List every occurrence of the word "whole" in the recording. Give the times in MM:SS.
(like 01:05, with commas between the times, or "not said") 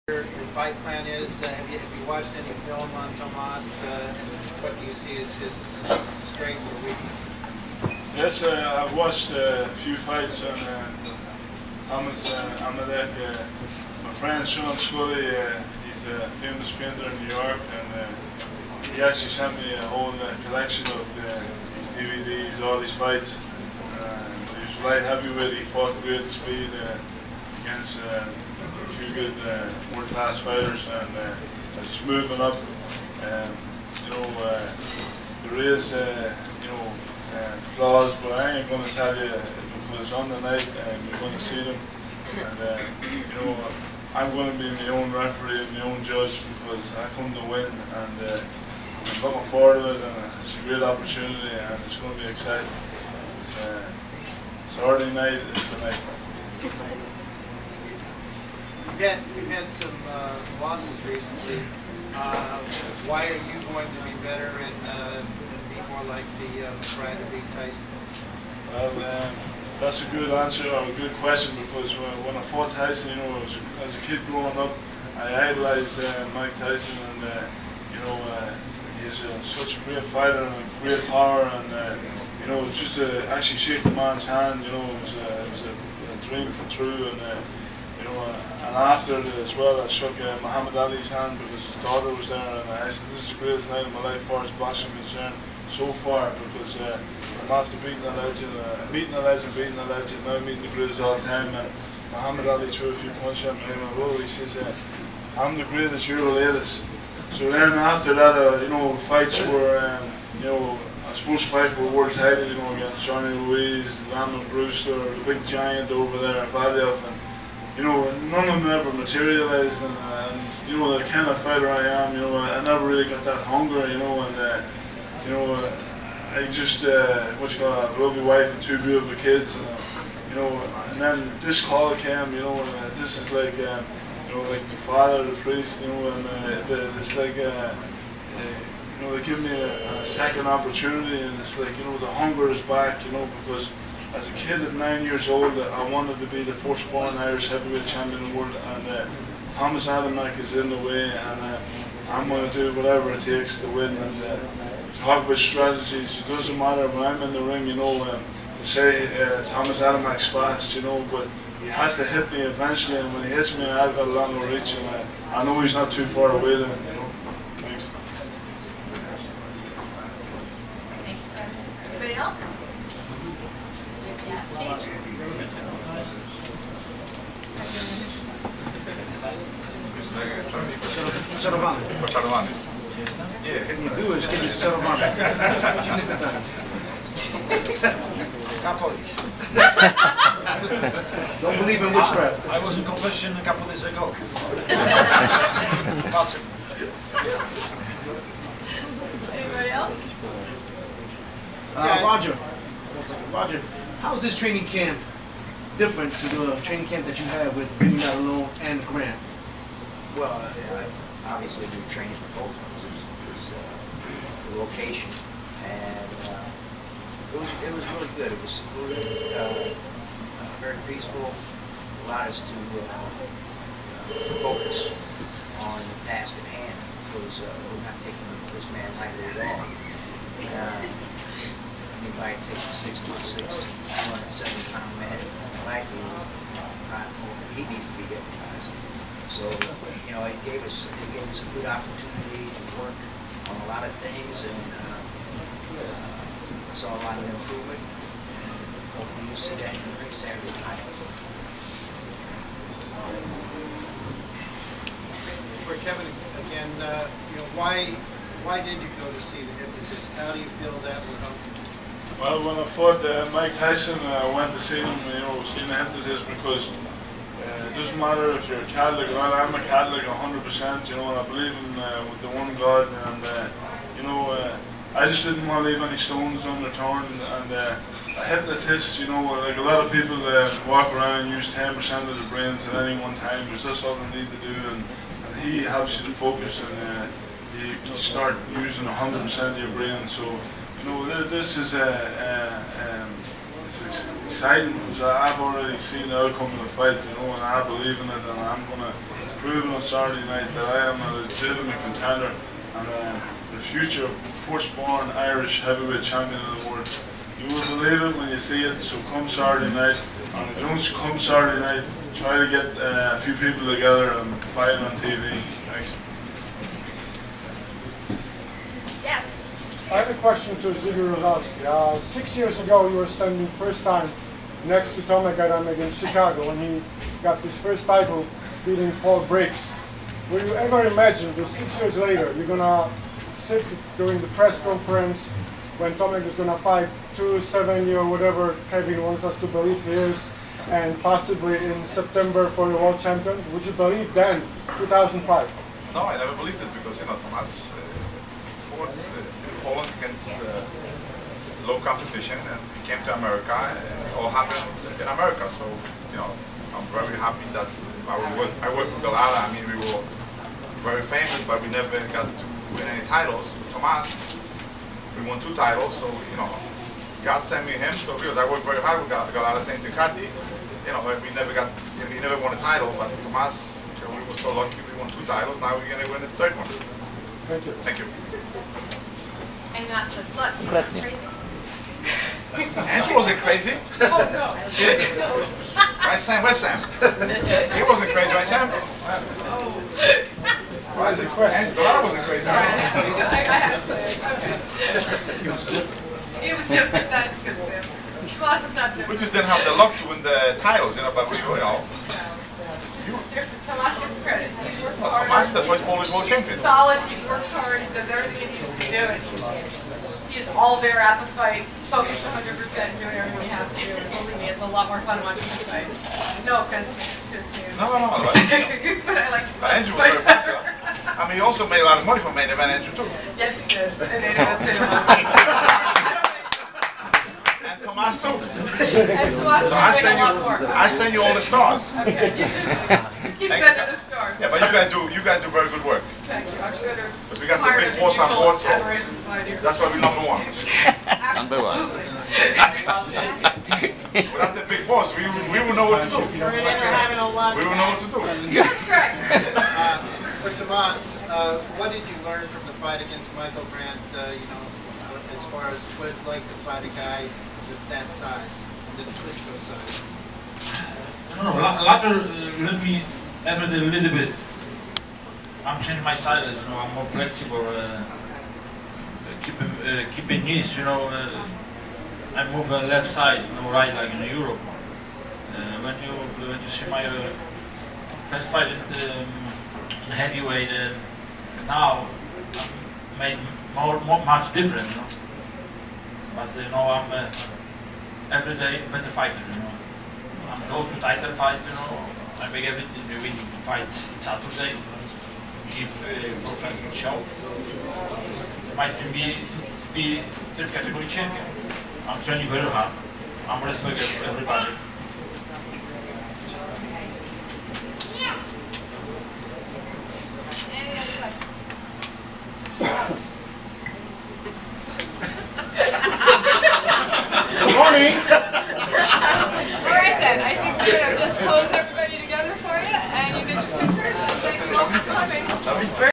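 00:19.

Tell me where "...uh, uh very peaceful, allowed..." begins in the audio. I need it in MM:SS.
03:38.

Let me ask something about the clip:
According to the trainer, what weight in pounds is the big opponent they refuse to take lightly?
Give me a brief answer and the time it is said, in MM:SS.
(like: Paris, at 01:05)
270, at 03:54.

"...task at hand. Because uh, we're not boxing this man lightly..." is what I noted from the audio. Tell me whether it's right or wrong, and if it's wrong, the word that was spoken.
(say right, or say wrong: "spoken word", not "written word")
wrong: "taking", not "boxing".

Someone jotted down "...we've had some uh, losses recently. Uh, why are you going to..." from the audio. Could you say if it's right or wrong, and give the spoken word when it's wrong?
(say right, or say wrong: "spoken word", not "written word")
right.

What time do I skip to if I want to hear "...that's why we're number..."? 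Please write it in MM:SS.
07:18.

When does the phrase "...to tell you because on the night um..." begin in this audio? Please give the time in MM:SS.
00:38.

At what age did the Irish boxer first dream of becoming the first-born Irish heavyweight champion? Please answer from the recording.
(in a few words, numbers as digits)
9.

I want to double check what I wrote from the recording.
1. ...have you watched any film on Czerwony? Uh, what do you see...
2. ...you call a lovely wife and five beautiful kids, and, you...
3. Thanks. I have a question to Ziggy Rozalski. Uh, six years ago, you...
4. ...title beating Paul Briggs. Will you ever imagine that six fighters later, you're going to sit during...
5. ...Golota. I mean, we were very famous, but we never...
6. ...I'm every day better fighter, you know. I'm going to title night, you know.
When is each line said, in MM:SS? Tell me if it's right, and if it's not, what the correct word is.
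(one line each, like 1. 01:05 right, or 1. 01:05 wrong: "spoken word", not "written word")
1. 00:01 wrong: "Tomas", not "Czerwony"
2. 02:07 wrong: "two", not "five"
3. 05:15 right
4. 05:27 wrong: "years", not "fighters"
5. 05:59 right
6. 08:06 wrong: "fight", not "night".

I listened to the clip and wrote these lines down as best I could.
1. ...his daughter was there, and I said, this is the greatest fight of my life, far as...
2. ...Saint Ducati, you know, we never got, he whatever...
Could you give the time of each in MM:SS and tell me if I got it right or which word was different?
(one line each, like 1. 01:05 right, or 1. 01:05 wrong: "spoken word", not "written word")
1. 01:31 wrong: "night", not "fight"
2. 06:09 wrong: "never", not "whatever".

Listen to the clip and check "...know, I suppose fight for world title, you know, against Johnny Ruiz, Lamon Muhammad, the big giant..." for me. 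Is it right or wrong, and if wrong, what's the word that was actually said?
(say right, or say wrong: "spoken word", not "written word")
wrong: "Brewster", not "Muhammad".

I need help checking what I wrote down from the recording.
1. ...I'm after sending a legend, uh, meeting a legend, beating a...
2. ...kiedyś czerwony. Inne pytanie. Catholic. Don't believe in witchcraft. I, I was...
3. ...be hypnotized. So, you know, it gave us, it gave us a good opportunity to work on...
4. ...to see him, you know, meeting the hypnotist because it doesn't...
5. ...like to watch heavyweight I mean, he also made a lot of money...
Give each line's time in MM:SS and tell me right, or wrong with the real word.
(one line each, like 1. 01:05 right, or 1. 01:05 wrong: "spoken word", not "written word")
1. 01:37 wrong: "beating", not "sending"
2. 03:04 right
3. 03:57 right
4. 04:24 wrong: "seeing", not "meeting"
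5. 06:59 wrong: "fight", not "heavyweight".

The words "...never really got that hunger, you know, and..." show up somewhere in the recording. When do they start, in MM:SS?
02:02.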